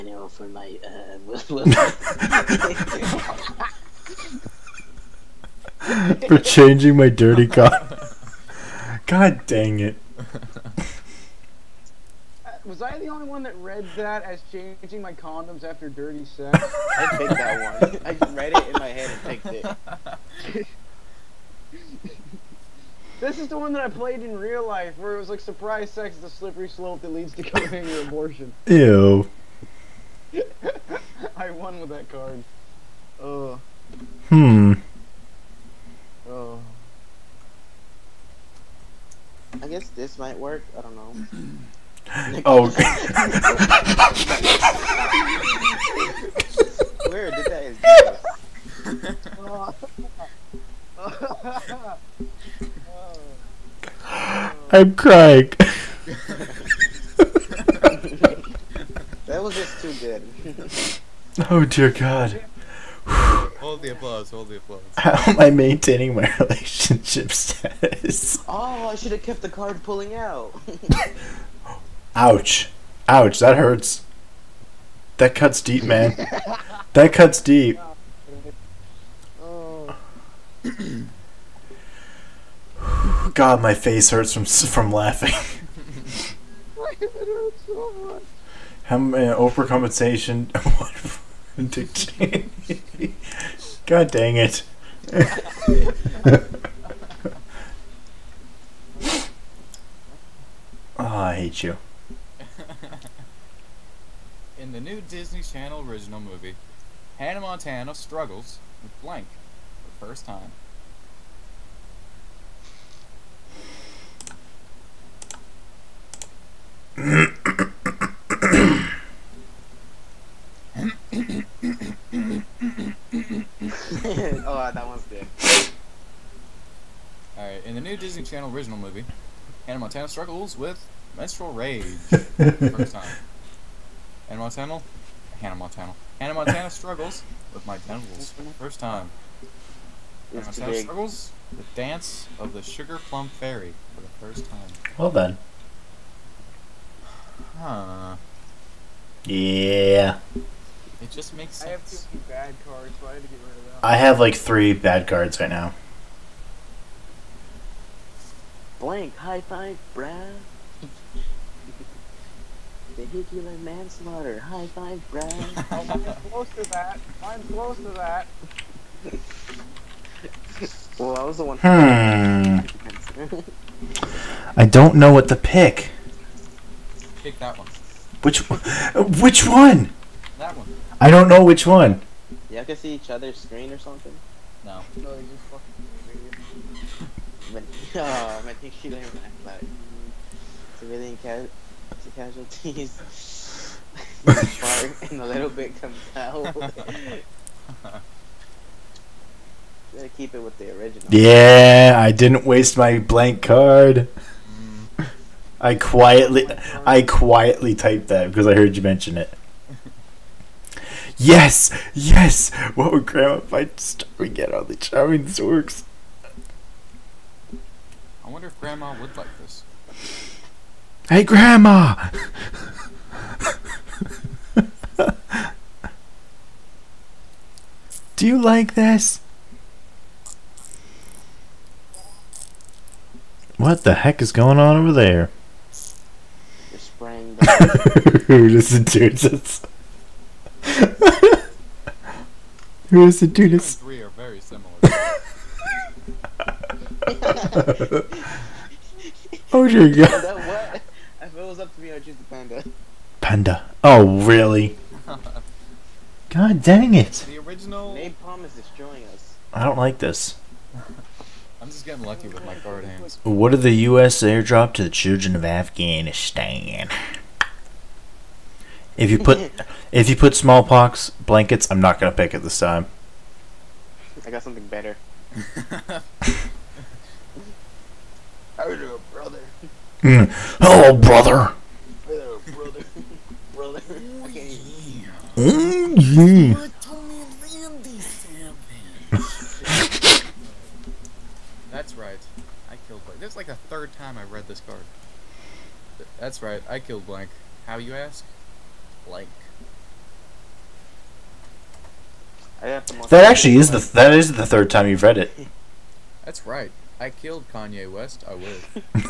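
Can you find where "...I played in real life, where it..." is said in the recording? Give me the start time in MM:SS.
00:23.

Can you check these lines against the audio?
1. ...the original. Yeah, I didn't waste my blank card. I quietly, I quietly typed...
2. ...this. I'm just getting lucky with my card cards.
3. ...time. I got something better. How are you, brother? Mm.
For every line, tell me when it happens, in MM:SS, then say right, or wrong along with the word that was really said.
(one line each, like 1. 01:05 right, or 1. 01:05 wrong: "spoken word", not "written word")
1. 03:20 right
2. 04:19 wrong: "hands", not "cards"
3. 04:32 right.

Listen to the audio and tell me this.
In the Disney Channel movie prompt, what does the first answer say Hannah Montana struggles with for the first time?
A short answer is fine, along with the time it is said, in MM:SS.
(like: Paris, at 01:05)
Menstrual rage, at 02:11.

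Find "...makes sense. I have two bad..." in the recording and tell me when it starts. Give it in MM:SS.
02:31.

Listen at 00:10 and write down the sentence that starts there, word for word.
Uh, was I the only one that read that as changing my condoms after dirty sex?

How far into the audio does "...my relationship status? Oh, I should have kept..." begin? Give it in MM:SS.
01:06.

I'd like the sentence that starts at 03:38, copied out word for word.
I wonder if Grandma would like this.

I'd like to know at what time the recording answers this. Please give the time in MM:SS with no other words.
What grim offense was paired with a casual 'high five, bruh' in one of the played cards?
02:42.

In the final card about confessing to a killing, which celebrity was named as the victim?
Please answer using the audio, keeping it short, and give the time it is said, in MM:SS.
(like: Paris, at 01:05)
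Kanye West, at 05:07.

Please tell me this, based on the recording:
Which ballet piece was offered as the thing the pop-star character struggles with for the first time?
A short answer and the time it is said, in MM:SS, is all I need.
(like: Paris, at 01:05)
Dance of the Sugar Plum Fairy, at 02:21.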